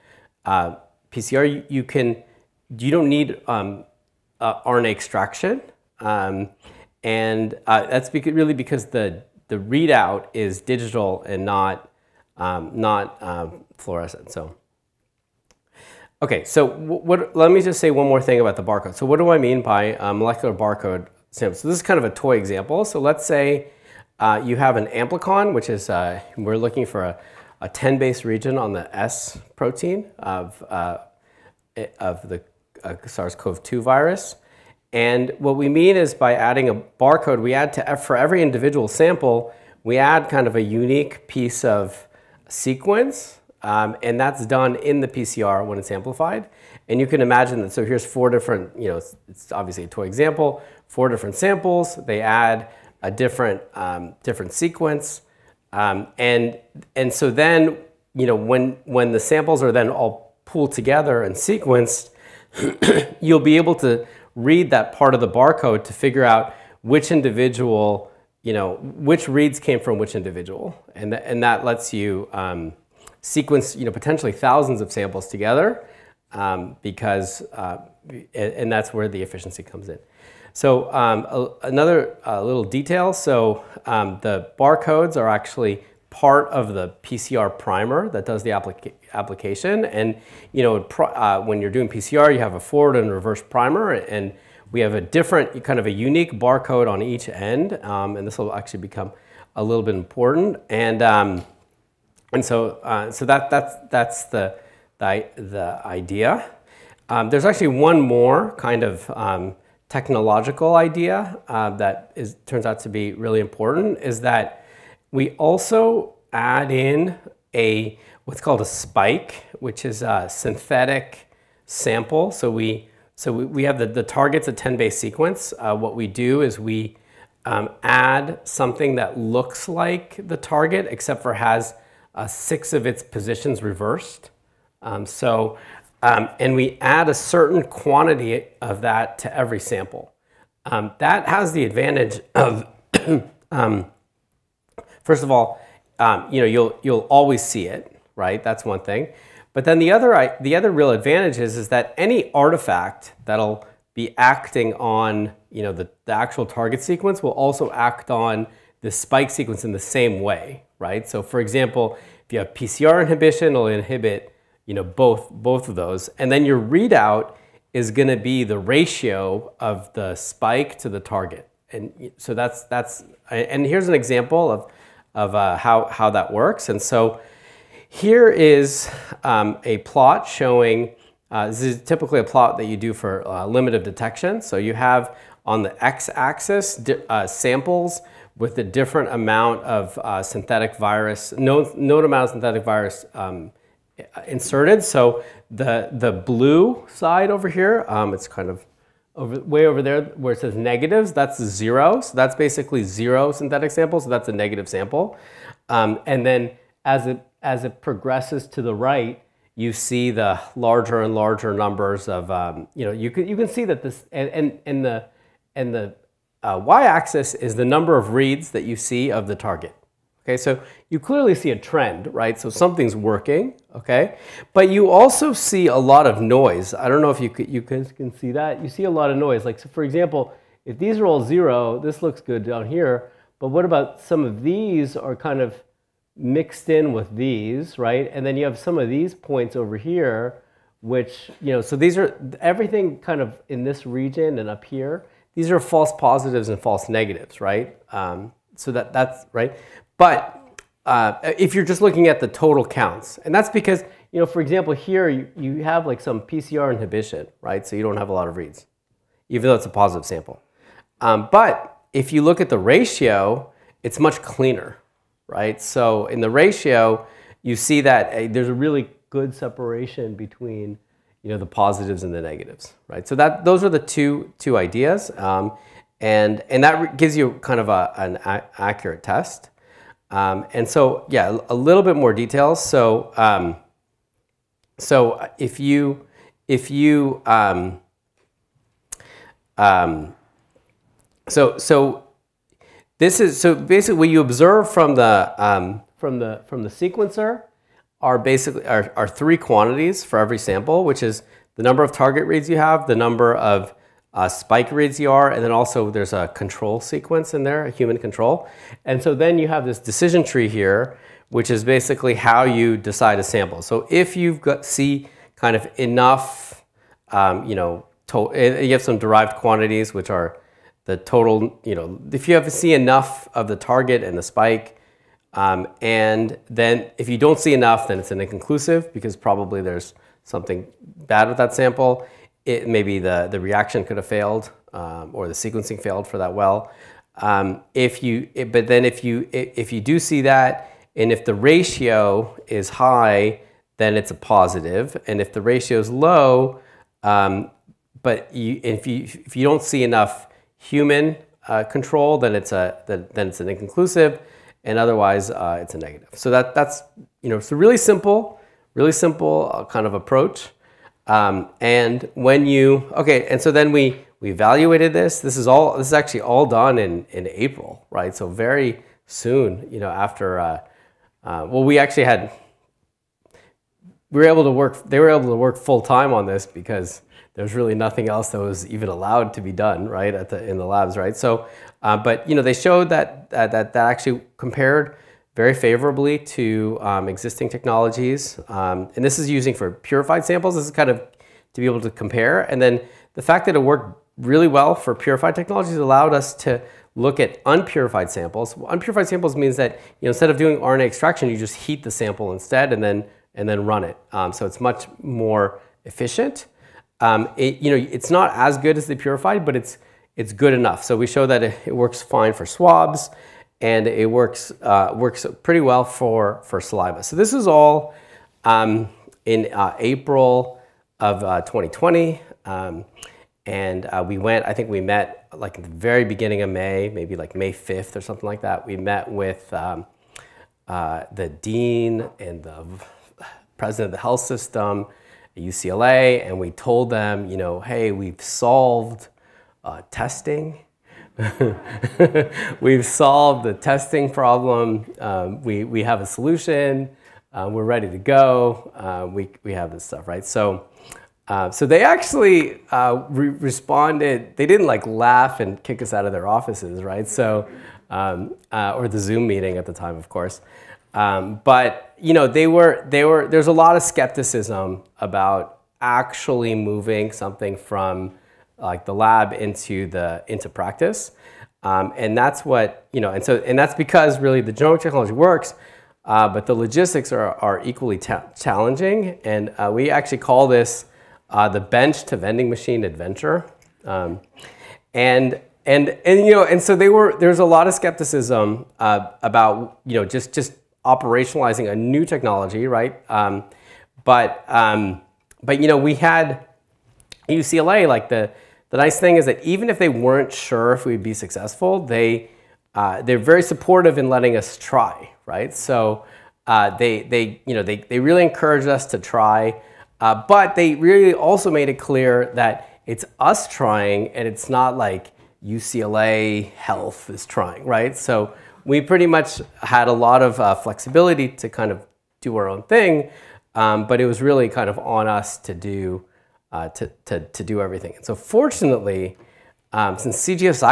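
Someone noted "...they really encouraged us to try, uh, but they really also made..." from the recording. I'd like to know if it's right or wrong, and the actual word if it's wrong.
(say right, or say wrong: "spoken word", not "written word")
right.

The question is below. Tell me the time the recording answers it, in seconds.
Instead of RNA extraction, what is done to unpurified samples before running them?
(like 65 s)
401 s.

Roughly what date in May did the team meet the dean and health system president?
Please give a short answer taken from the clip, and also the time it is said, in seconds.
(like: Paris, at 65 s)
May 5, at 427 s.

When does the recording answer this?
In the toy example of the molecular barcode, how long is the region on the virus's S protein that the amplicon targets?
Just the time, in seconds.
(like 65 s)
27 s.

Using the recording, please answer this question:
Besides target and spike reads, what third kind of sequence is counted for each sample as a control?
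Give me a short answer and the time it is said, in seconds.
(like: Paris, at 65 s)
human control, at 307 s.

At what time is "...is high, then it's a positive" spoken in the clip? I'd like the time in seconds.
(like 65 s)
342 s.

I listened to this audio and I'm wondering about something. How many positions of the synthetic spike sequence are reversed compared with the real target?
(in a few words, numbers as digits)
6.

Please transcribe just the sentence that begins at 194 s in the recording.
So the, the blue side over here, um, it's kind of over, way over there where it says negatives, that's zero.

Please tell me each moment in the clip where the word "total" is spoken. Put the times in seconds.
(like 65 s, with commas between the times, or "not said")
252 s, 320 s.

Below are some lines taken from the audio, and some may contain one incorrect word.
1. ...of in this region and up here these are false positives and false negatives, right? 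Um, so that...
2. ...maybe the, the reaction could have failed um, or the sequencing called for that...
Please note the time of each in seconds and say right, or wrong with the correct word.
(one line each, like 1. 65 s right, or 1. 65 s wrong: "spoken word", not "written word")
1. 243 s right
2. 332 s wrong: "failed", not "called".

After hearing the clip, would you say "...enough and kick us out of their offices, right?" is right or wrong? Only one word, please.
wrong.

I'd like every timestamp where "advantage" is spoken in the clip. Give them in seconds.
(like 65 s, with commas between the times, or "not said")
141 s, 150 s.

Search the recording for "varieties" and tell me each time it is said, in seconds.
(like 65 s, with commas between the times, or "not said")
not said.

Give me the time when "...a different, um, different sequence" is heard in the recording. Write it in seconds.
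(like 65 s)
53 s.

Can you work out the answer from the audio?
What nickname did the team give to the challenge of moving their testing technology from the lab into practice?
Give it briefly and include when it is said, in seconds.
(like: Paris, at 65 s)
bench to vending machine adventure, at 481 s.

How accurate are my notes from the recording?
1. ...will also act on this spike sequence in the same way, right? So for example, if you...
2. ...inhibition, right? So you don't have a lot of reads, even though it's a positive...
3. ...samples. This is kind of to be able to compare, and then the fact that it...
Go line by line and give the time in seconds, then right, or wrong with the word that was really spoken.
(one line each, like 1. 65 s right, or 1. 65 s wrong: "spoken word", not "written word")
1. 157 s right
2. 256 s right
3. 390 s right.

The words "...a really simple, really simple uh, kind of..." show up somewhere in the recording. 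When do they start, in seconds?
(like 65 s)
357 s.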